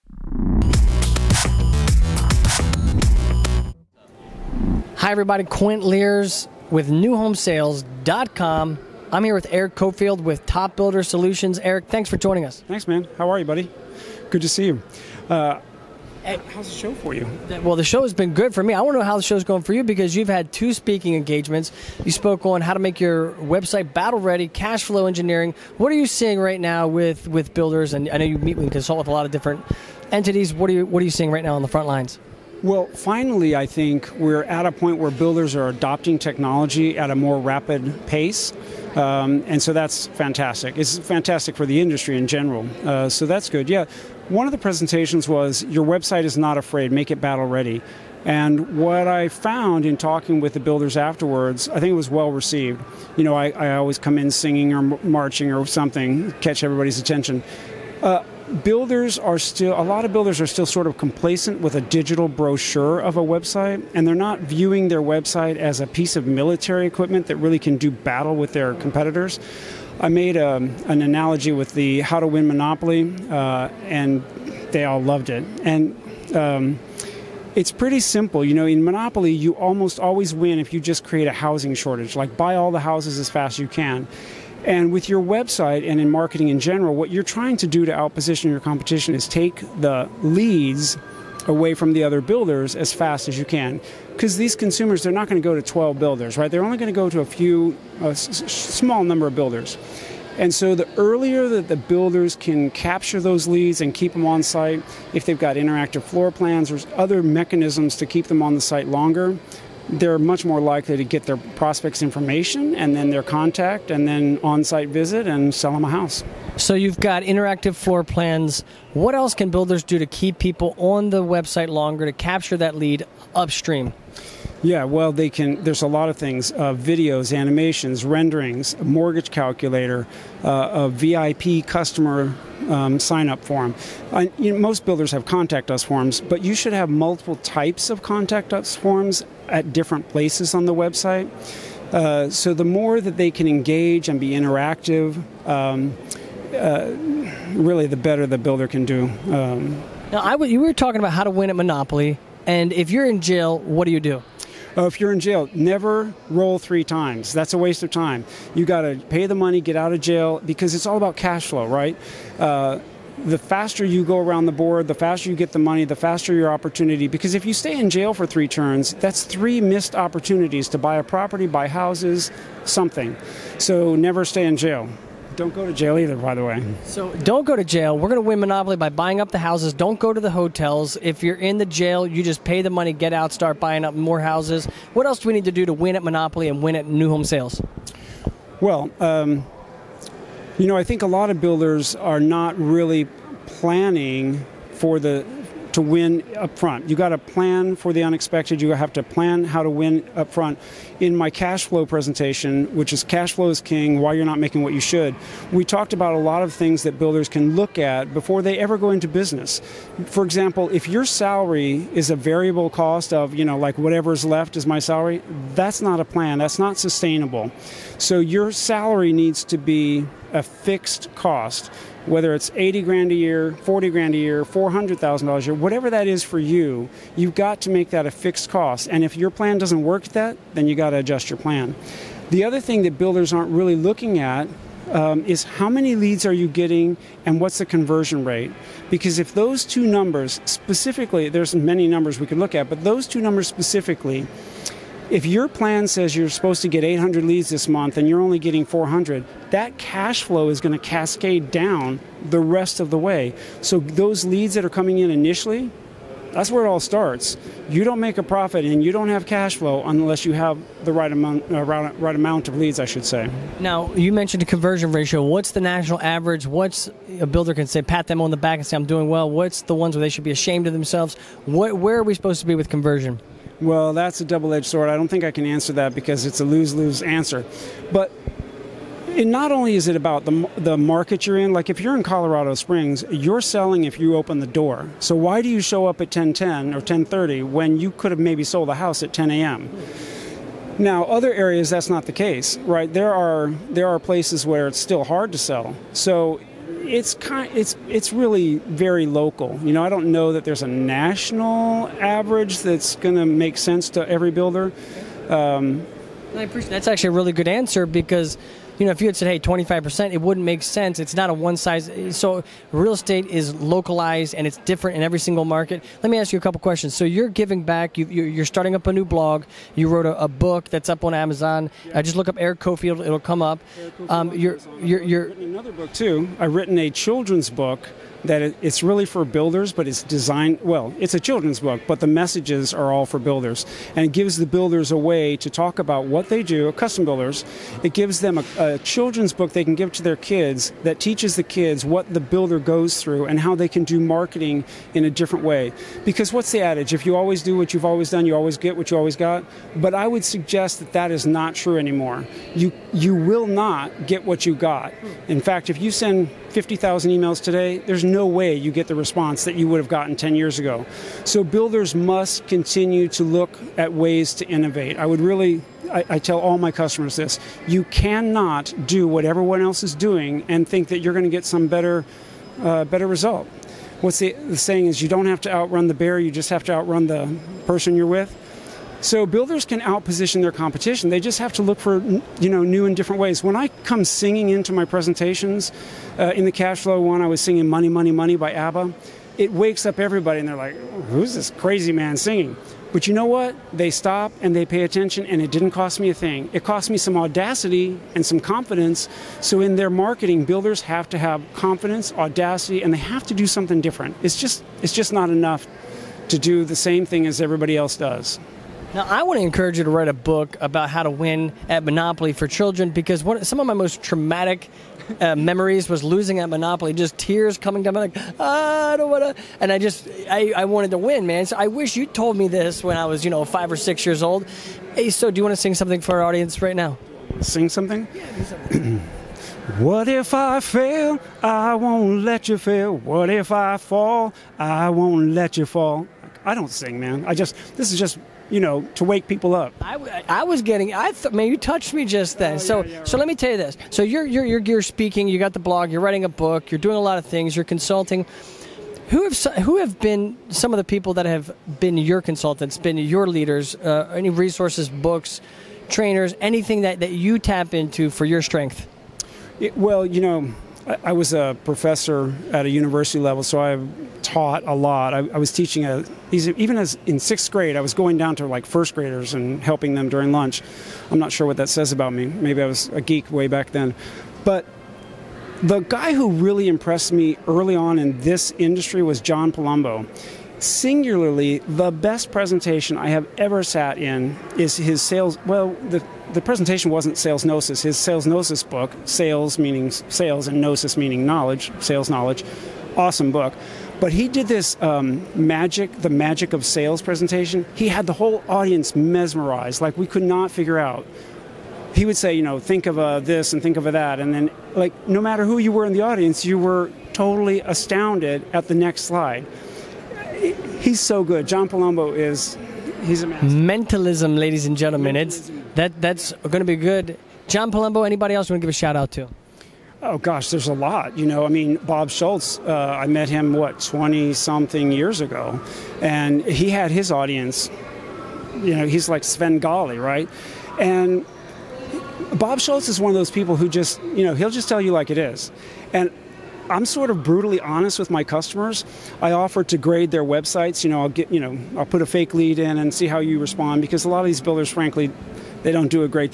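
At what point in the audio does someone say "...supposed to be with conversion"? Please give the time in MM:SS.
04:32.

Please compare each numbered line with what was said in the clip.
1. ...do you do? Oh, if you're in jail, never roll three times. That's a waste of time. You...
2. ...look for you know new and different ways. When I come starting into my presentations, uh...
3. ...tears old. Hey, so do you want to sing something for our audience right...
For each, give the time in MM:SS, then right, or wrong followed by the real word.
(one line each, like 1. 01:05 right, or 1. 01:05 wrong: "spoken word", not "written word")
1. 02:33 right
2. 06:21 wrong: "singing", not "starting"
3. 07:04 wrong: "years", not "tears".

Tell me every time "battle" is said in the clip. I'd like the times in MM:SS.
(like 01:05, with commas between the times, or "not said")
00:23, 00:47, 01:07.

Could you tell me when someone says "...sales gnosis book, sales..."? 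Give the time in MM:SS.
08:07.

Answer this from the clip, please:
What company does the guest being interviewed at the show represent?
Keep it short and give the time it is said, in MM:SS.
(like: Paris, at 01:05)
Top Builder Solutions, at 00:10.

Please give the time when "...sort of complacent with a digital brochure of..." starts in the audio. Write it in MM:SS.
01:00.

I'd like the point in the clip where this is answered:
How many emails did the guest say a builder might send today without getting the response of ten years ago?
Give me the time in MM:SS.
05:56.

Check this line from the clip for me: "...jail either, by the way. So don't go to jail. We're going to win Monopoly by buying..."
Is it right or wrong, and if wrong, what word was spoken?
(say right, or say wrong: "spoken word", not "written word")
right.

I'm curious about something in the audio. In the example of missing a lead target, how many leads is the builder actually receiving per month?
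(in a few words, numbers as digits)
400.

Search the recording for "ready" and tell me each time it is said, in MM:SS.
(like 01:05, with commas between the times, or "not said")
00:24, 00:47.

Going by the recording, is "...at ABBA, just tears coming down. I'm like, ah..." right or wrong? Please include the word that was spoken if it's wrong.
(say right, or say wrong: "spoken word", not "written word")
wrong: "Monopoly", not "ABBA".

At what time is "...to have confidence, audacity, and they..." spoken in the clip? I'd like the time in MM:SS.
06:41.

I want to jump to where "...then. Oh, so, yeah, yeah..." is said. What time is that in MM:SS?
07:22.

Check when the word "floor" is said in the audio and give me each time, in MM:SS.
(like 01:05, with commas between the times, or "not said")
01:46, 01:57.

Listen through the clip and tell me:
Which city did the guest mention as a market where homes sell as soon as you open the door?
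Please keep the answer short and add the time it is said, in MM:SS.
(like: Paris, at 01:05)
Colorado Springs, at 04:42.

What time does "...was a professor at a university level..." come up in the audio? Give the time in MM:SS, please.
07:41.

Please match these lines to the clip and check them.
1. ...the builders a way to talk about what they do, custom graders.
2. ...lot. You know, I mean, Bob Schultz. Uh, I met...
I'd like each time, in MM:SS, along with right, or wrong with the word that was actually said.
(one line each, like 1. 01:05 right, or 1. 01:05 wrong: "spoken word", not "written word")
1. 05:34 wrong: "builders", not "graders"
2. 08:40 right.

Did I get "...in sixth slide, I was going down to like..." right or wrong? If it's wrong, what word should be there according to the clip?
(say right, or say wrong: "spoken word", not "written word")
wrong: "grade", not "slide".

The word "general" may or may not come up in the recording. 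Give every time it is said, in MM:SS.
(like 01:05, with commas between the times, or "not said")
00:42, 01:26.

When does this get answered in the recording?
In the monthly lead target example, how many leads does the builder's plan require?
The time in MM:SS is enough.
04:06.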